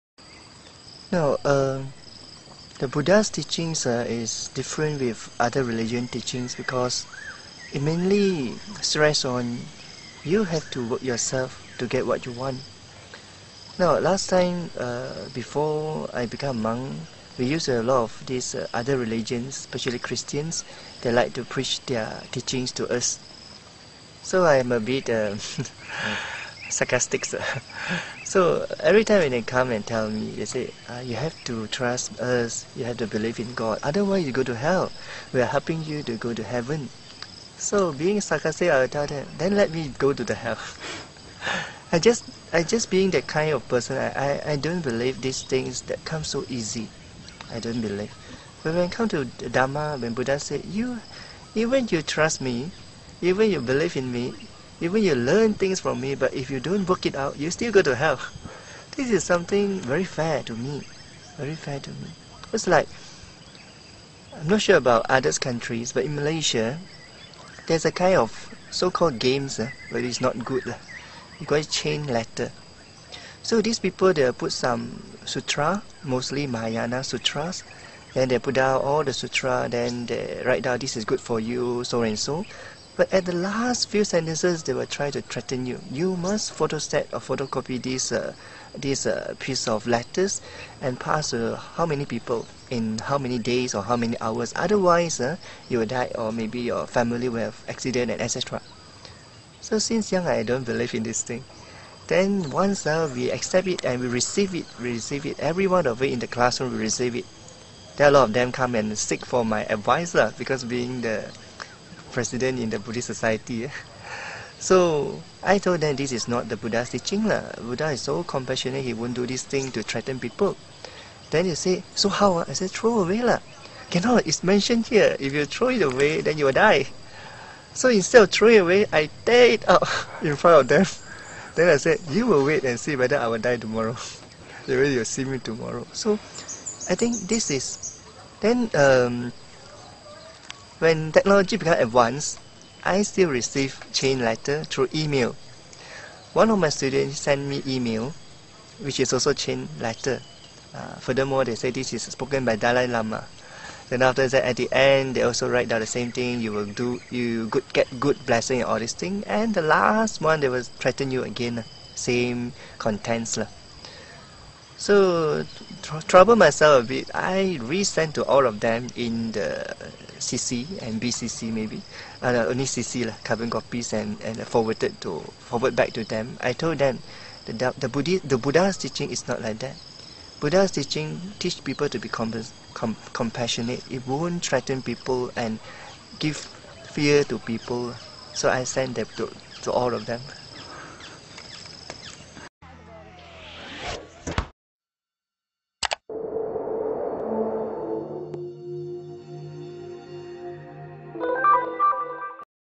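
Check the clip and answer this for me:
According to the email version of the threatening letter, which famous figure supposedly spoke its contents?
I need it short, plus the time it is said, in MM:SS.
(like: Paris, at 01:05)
Dalai Lama, at 02:32.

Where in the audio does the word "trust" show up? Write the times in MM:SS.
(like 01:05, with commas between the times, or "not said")
00:31, 00:52.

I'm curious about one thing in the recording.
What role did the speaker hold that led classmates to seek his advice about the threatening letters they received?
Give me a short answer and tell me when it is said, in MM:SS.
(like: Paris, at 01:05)
President in the Buddhist society, at 01:52.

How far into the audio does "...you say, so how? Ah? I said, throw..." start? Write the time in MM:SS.
02:01.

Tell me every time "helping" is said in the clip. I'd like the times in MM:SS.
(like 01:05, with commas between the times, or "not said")
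00:35.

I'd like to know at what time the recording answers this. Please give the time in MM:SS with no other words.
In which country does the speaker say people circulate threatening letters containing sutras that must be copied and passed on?
01:06.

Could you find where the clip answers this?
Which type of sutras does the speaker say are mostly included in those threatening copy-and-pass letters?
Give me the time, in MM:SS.
01:16.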